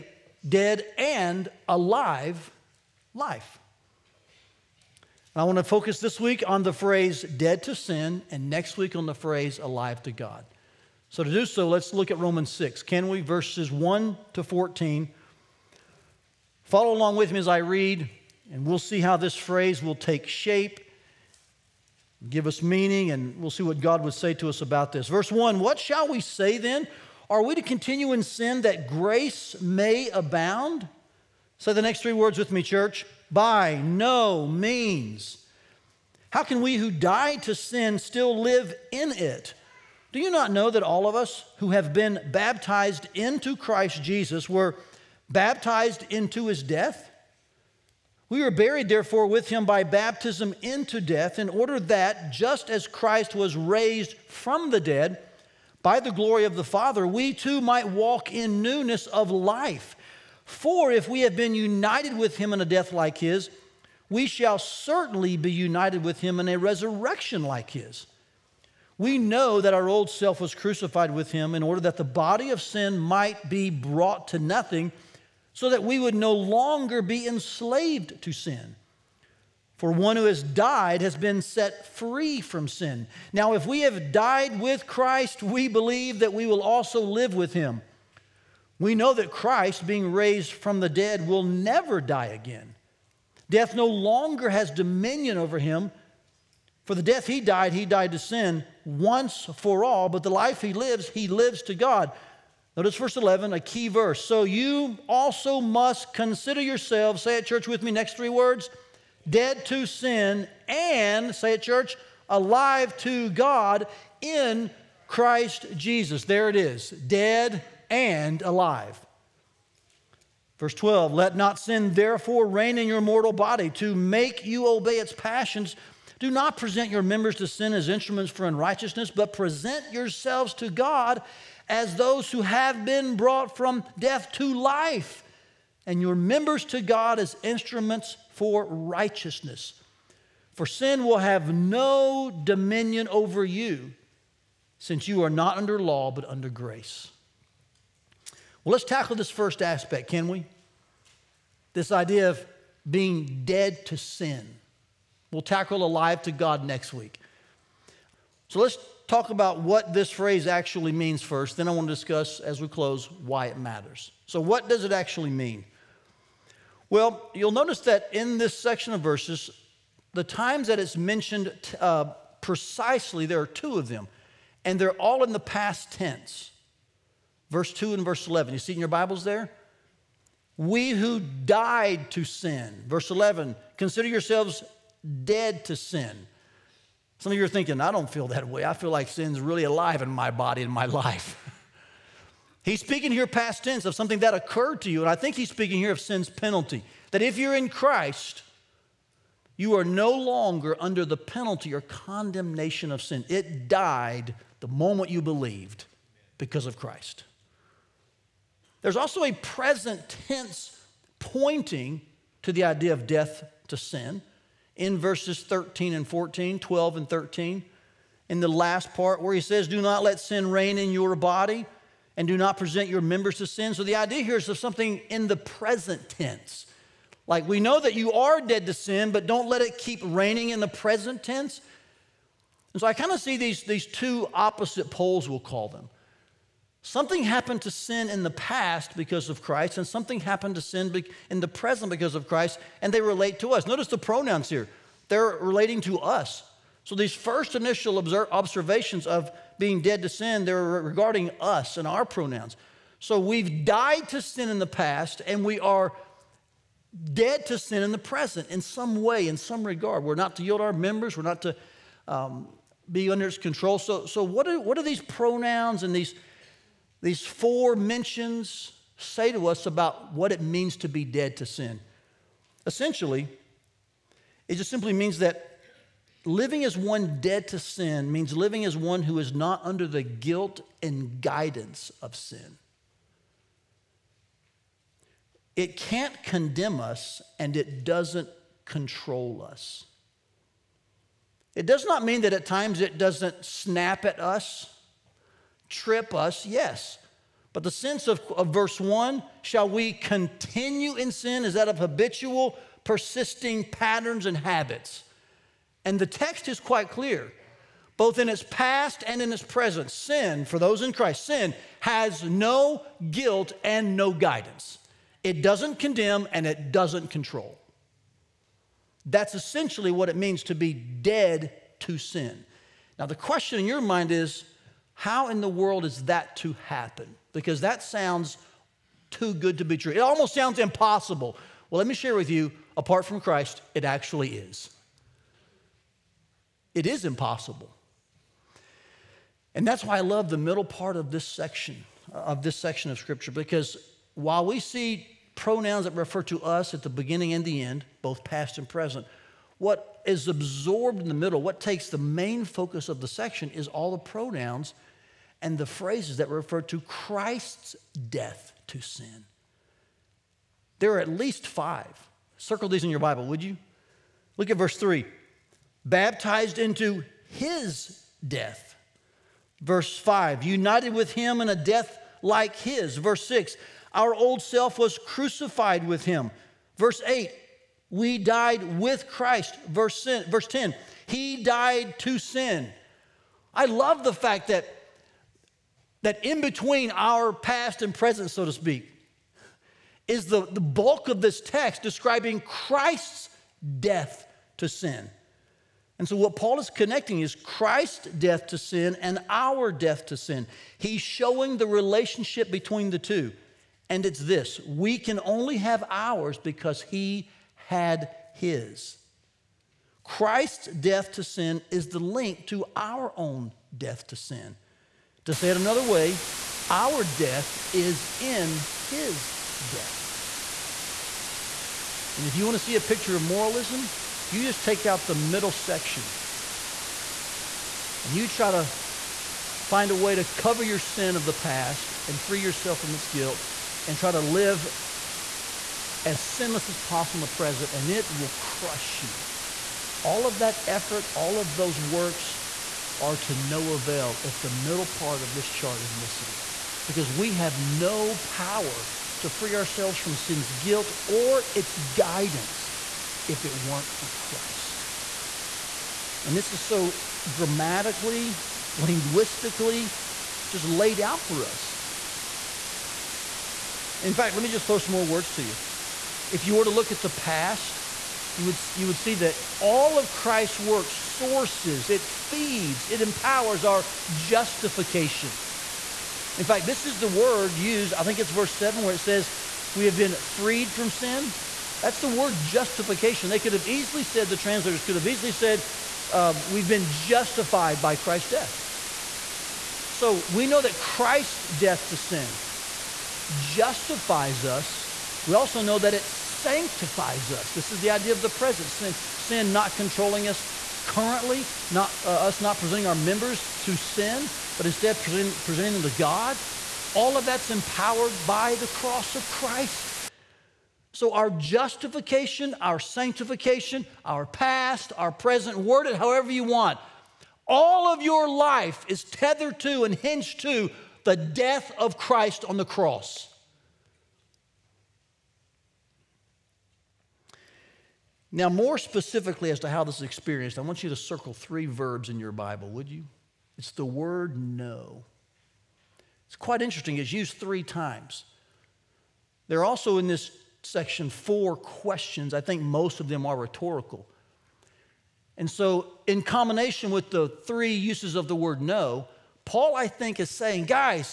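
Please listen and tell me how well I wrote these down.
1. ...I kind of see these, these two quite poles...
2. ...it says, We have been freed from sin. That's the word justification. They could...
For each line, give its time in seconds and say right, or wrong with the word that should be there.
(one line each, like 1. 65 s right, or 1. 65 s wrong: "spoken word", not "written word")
1. 232 s wrong: "opposite", not "quite"
2. 478 s right.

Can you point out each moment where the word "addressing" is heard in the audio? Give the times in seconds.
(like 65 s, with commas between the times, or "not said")
not said.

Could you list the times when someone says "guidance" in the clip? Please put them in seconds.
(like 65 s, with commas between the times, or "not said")
281 s, 314 s, 451 s.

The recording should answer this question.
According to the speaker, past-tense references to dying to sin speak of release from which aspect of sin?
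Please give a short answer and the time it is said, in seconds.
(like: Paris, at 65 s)
sin's penalty, at 195 s.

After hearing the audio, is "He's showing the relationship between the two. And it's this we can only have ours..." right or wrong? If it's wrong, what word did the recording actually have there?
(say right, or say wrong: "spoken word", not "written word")
right.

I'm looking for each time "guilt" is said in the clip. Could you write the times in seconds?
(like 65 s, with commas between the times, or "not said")
280 s, 313 s, 433 s, 450 s.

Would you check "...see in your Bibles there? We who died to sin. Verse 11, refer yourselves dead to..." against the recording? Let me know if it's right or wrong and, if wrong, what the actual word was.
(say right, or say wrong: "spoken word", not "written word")
wrong: "consider", not "refer".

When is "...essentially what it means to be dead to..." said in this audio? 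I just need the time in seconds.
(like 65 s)
319 s.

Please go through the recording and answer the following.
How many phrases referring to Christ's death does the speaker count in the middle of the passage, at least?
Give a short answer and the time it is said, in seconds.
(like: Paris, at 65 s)
5, at 361 s.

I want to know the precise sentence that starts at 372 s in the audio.
Verse 6 our old self was crucified with him.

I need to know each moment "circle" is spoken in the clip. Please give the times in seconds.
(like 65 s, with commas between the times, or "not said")
362 s, 530 s.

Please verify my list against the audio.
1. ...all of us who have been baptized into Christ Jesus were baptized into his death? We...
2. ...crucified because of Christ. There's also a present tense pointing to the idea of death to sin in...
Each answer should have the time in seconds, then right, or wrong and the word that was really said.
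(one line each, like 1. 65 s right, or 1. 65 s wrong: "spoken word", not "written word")
1. 40 s right
2. 205 s wrong: "believed", not "crucified".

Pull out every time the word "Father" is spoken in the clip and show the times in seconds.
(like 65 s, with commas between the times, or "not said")
56 s.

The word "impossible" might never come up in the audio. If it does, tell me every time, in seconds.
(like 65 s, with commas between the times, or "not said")
330 s, 337 s.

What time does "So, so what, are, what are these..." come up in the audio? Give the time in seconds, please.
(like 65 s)
263 s.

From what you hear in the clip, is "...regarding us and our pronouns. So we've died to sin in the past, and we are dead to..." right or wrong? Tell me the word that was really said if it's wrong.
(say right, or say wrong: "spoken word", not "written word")
right.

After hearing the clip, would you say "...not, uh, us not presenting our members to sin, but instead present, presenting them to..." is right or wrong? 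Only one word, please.
right.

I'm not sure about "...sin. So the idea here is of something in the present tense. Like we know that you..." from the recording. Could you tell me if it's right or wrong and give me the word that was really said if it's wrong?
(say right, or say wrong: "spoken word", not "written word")
right.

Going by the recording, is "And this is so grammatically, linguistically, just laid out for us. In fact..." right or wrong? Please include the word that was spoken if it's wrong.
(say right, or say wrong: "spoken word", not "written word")
right.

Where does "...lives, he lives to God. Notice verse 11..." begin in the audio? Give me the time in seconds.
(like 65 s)
100 s.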